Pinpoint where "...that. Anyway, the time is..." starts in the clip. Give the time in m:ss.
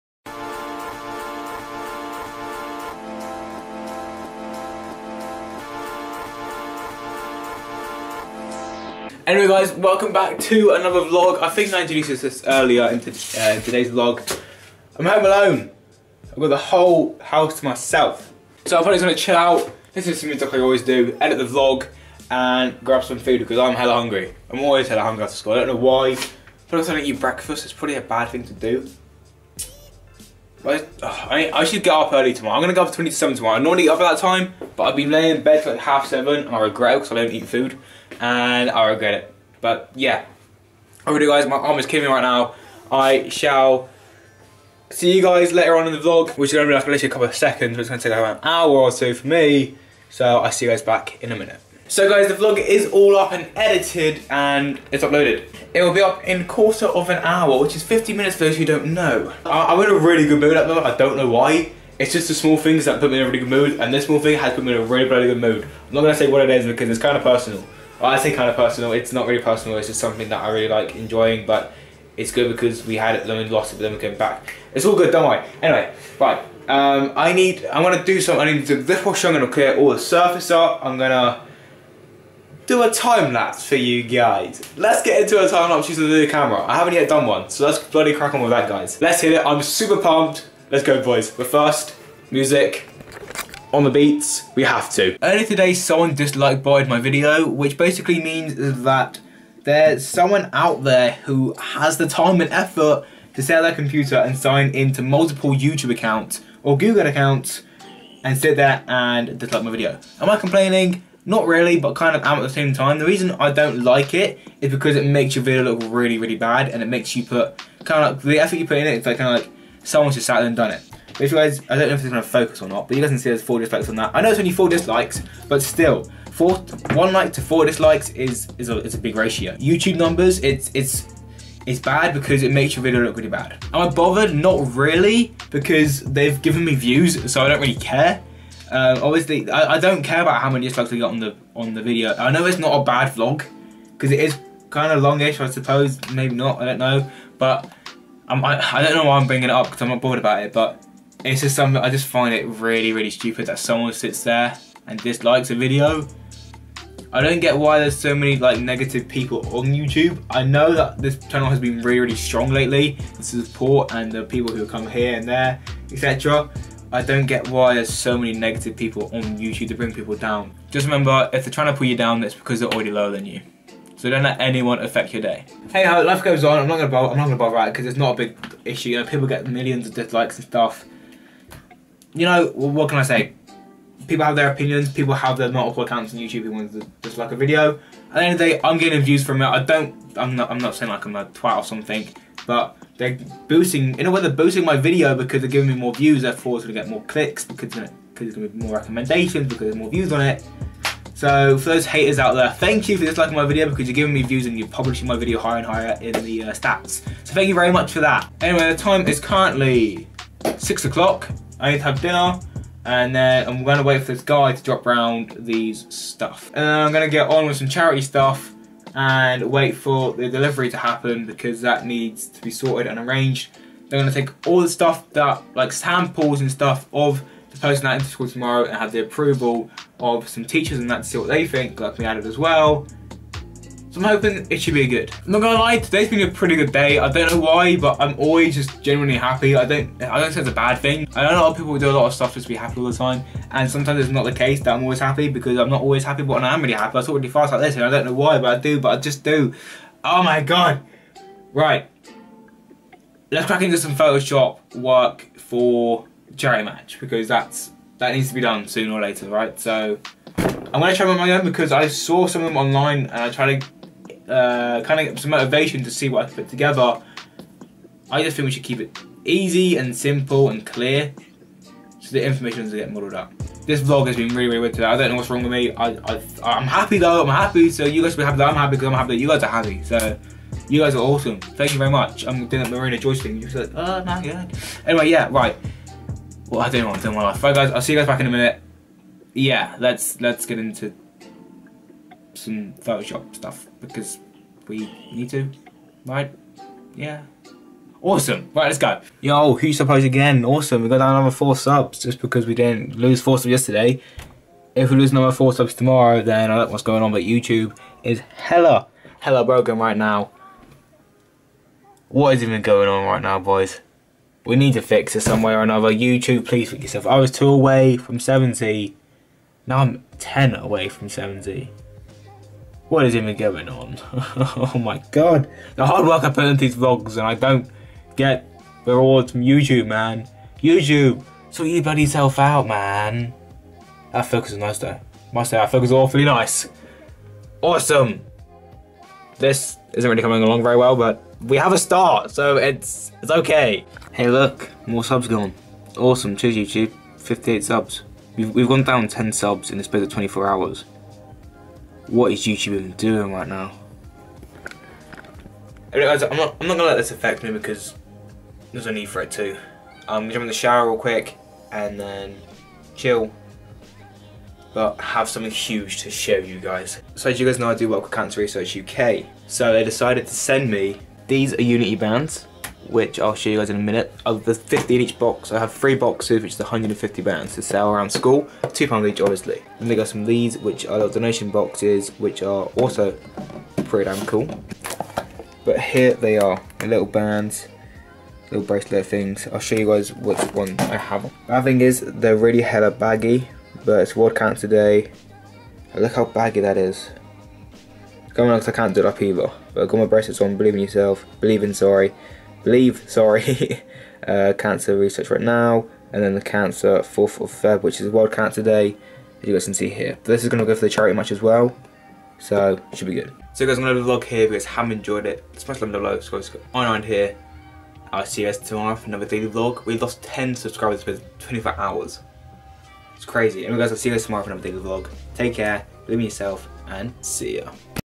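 3:28.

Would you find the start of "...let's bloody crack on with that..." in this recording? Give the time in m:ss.
1:27.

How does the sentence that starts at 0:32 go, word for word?
I'm gonna go up 27 tomorrow.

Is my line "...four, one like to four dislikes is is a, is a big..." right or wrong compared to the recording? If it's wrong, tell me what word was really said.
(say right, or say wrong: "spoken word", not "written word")
right.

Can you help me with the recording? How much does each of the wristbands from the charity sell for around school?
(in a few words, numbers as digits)
2 pounds.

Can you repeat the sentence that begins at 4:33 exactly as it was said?
This vlog has been really, really weird today.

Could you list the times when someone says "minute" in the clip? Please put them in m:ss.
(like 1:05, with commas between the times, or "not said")
0:51, 0:58, 4:48, 6:13.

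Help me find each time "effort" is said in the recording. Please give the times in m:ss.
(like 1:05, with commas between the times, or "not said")
1:42, 1:58.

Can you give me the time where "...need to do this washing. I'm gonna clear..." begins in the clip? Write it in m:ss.
1:18.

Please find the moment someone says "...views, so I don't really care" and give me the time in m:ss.
2:16.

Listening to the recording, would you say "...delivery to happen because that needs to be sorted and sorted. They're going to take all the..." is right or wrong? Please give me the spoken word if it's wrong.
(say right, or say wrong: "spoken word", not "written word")
wrong: "arranged", not "sorted".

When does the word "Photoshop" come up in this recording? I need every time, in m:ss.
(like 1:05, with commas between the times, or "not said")
4:13, 4:52.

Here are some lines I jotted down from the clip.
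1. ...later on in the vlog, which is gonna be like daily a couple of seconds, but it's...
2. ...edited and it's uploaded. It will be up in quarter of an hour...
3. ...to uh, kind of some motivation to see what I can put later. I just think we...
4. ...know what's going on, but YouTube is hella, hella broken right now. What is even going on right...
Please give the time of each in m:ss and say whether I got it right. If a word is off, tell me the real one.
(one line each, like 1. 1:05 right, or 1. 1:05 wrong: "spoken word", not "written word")
1. 0:45 wrong: "literally", not "daily"
2. 0:53 right
3. 4:23 wrong: "together", not "later"
4. 5:06 right.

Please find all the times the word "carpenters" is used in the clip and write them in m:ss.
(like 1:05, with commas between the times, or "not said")
not said.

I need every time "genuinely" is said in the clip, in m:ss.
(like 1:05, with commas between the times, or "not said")
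3:58.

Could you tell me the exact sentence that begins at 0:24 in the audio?
I'm always hella hungry after school, I don't know why.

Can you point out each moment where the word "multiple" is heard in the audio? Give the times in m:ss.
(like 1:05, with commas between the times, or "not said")
1:45, 3:05.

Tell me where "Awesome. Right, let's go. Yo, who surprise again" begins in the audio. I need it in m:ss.
4:58.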